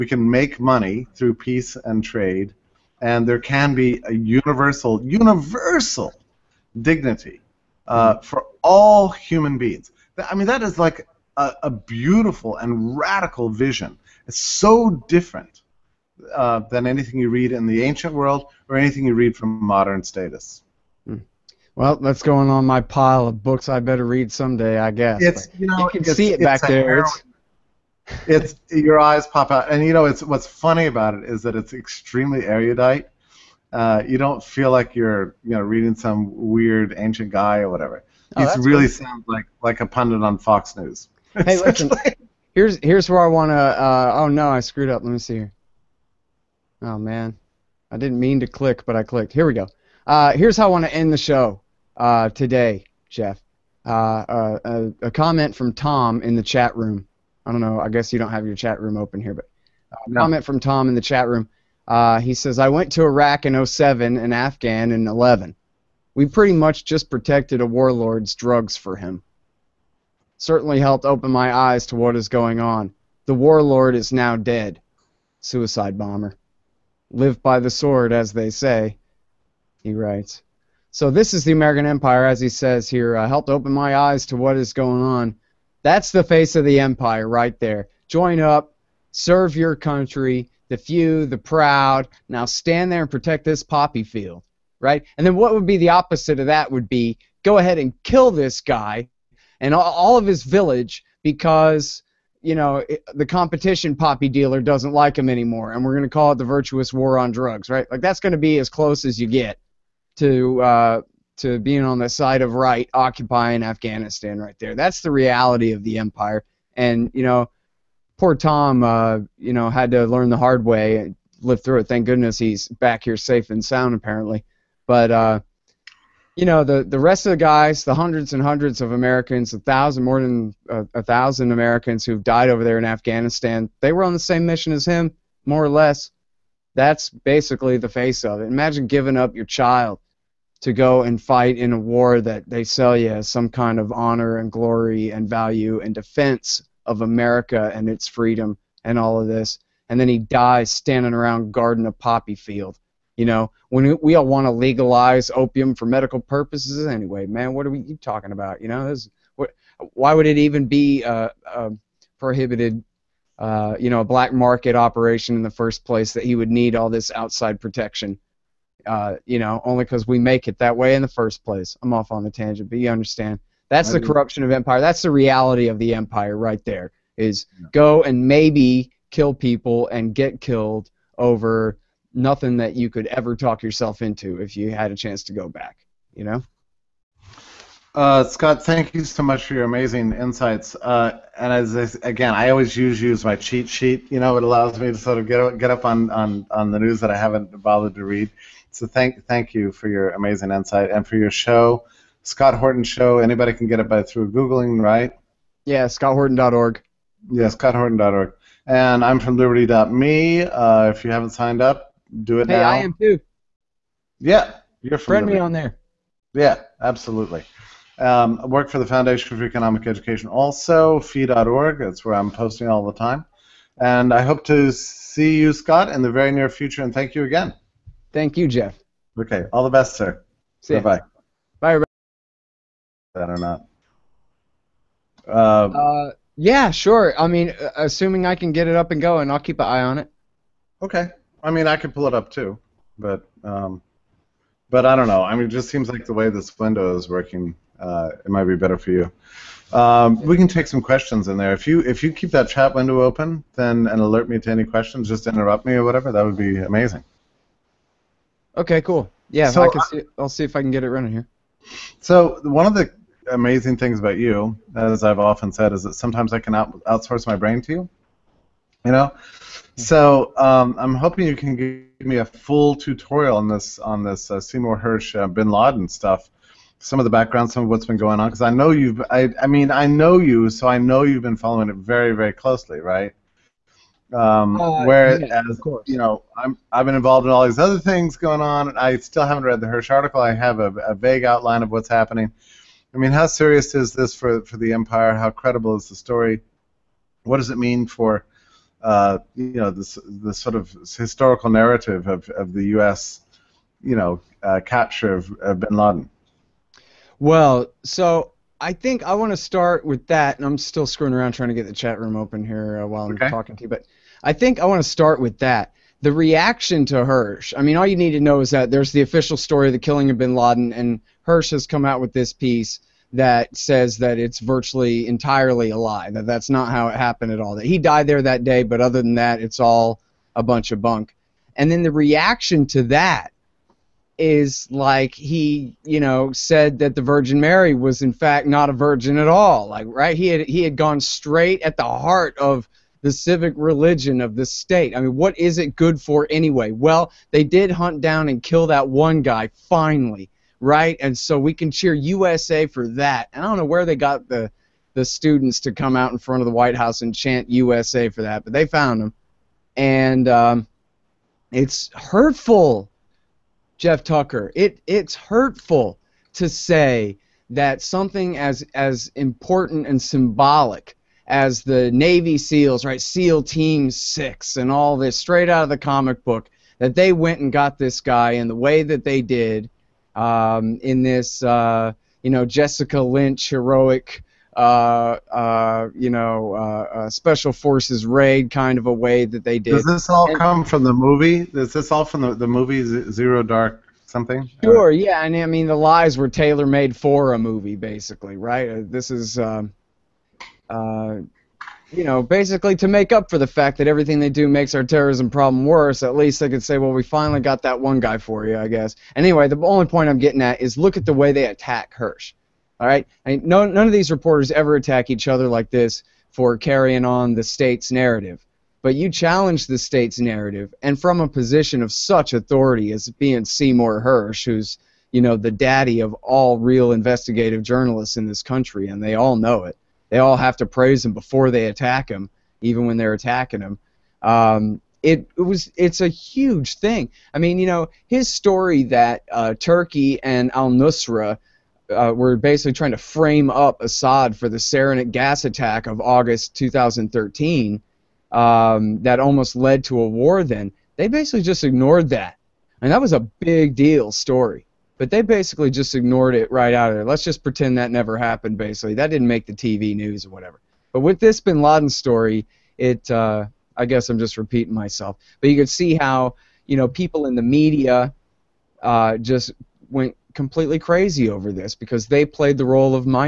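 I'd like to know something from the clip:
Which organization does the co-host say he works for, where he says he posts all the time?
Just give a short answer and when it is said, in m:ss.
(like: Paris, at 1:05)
Foundation for Economic Education, at 3:38.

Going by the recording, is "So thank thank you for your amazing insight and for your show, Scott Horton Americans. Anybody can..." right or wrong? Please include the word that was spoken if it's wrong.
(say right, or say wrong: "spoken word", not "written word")
wrong: "Show", not "Americans".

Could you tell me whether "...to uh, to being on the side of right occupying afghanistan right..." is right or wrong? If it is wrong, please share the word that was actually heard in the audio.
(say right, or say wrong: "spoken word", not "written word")
right.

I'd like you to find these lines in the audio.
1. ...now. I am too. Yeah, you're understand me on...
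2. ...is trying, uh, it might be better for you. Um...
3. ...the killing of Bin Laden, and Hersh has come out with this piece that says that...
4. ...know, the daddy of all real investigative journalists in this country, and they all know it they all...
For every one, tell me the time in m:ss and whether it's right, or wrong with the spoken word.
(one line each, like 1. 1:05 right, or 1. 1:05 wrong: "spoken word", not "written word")
1. 3:32 wrong: "friend", not "understand"
2. 4:06 wrong: "working", not "trying"
3. 5:19 right
4. 7:05 right.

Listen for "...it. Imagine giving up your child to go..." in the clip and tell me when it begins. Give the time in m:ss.
2:18.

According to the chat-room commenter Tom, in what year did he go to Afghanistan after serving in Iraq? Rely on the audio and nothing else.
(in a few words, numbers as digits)
2011.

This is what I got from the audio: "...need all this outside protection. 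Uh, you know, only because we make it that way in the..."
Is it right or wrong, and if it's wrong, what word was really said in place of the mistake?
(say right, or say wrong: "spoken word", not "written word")
right.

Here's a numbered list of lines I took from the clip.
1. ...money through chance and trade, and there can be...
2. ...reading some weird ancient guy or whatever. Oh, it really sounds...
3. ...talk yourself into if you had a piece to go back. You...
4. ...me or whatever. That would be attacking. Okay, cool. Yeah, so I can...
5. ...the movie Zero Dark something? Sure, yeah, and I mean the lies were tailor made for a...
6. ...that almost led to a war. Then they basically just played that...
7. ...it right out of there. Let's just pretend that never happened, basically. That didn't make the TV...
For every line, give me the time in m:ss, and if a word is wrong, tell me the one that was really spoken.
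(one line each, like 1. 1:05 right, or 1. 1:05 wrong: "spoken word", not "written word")
1. 0:00 wrong: "peace", not "chance"
2. 0:35 right
3. 3:03 wrong: "chance", not "piece"
4. 4:15 wrong: "amazing", not "attacking"
5. 6:32 right
6. 7:29 wrong: "ignored", not "played"
7. 7:36 right.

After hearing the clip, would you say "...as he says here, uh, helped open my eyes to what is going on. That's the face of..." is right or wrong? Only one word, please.
right.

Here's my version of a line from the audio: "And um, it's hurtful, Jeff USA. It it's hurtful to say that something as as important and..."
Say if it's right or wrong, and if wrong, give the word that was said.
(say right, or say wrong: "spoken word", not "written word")
wrong: "Tucker", not "USA".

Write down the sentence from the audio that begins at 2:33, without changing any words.
You know, when we, all want to legalize opium for medical purposes anyway, man, what are we talking about?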